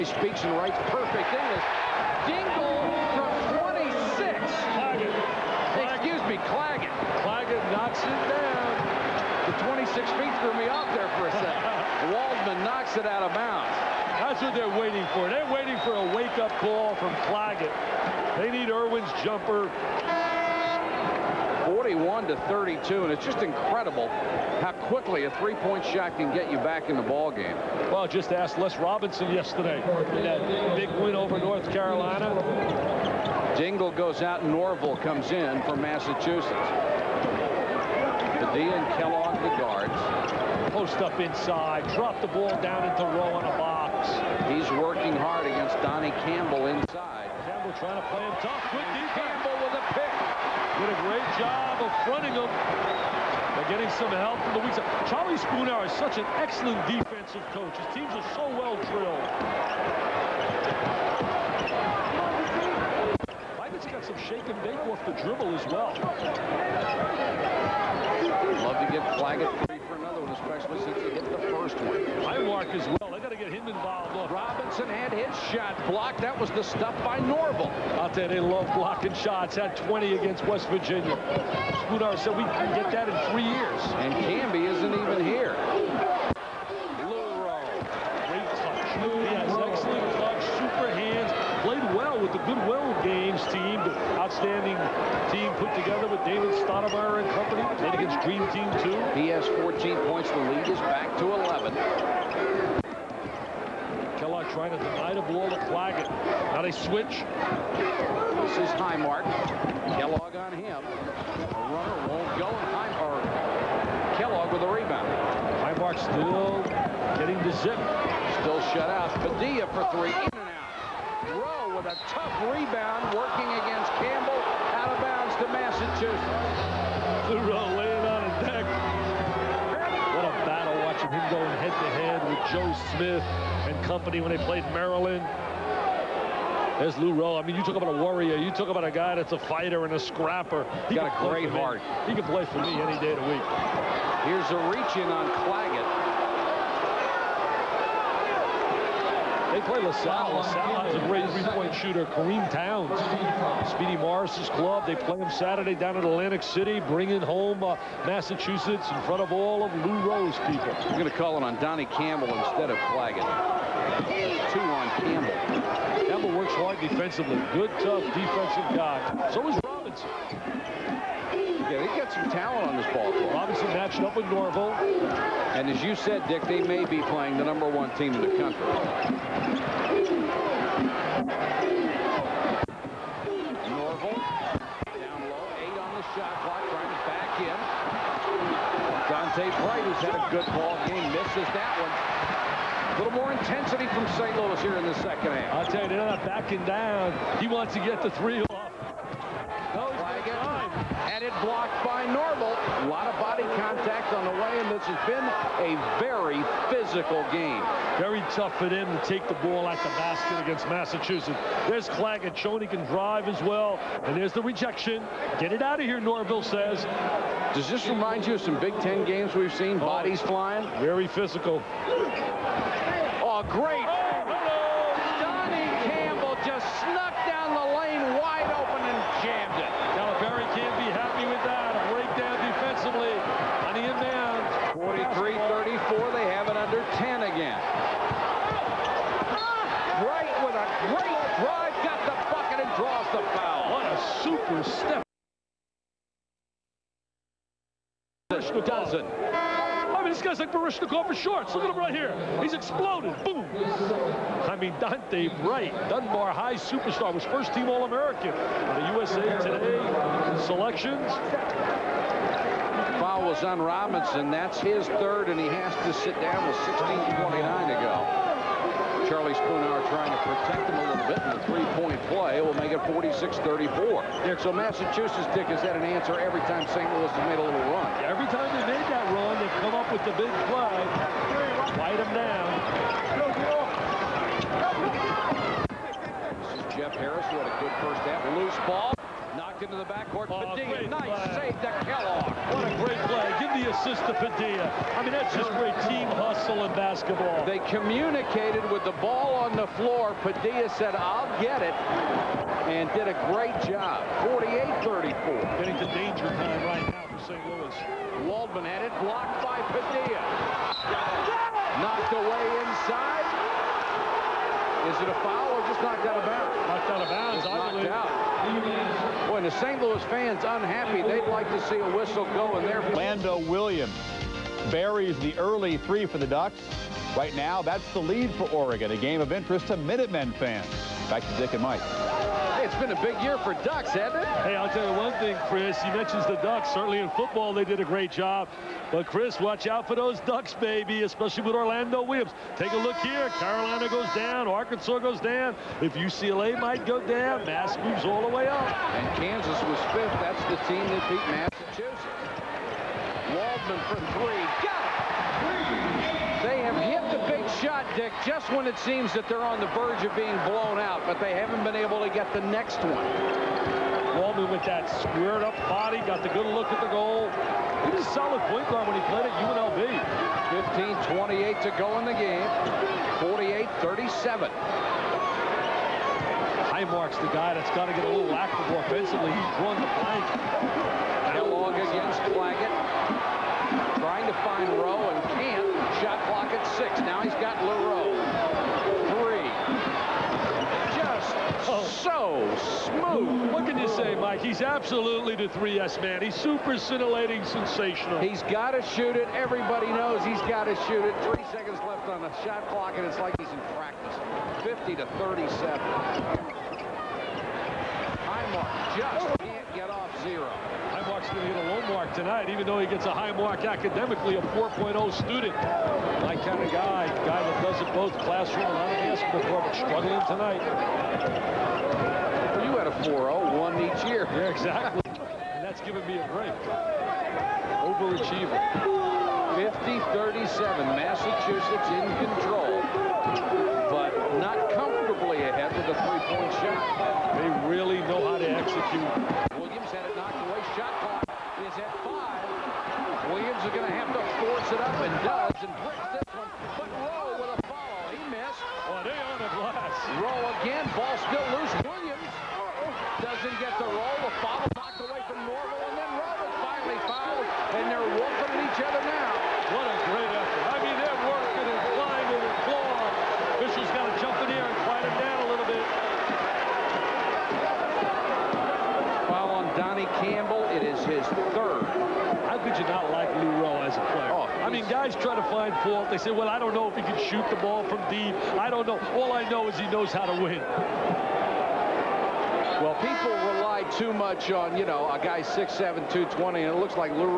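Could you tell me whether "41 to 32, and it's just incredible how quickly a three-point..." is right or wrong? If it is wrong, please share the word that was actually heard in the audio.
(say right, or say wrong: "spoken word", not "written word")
right.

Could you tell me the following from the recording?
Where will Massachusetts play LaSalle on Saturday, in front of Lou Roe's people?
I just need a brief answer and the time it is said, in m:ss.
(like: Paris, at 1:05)
Atlantic City, at 2:36.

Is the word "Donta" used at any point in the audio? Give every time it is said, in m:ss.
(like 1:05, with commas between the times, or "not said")
3:09, 4:14.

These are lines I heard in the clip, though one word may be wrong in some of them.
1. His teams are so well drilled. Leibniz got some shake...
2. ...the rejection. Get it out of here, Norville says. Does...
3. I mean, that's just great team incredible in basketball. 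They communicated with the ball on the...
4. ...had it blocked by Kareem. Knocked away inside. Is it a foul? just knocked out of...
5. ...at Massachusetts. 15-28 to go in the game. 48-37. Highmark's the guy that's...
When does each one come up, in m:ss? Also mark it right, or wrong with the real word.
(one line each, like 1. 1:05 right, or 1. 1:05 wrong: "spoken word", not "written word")
1. 0:57 right
2. 3:34 right
3. 4:54 wrong: "hustle", not "incredible"
4. 5:08 wrong: "Padilla", not "Kareem"
5. 6:09 wrong: "UNLV", not "Massachusetts".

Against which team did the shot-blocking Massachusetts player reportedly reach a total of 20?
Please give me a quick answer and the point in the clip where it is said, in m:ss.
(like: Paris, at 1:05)
West Virginia, at 1:20.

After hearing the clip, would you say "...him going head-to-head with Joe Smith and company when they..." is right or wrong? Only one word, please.
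right.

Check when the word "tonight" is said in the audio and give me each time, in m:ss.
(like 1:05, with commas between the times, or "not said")
6:52, 7:00.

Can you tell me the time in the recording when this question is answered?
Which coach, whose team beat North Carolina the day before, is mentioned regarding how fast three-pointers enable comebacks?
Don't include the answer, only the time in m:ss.
0:28.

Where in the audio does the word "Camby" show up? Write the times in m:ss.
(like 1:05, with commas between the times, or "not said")
1:24.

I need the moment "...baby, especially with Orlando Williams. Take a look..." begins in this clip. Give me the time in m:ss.
5:40.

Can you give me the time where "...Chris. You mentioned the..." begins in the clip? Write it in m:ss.
5:35.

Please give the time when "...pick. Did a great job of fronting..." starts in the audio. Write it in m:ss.
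0:49.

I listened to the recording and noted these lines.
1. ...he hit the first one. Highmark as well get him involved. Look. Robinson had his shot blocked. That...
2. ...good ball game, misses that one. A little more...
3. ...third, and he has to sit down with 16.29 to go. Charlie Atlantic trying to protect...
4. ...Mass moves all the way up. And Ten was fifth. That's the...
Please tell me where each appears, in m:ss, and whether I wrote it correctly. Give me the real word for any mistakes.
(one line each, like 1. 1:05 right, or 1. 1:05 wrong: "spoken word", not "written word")
1. 1:11 right
2. 3:10 right
3. 4:24 wrong: "Spoonhour", not "Atlantic"
4. 5:47 wrong: "Kansas", not "Ten".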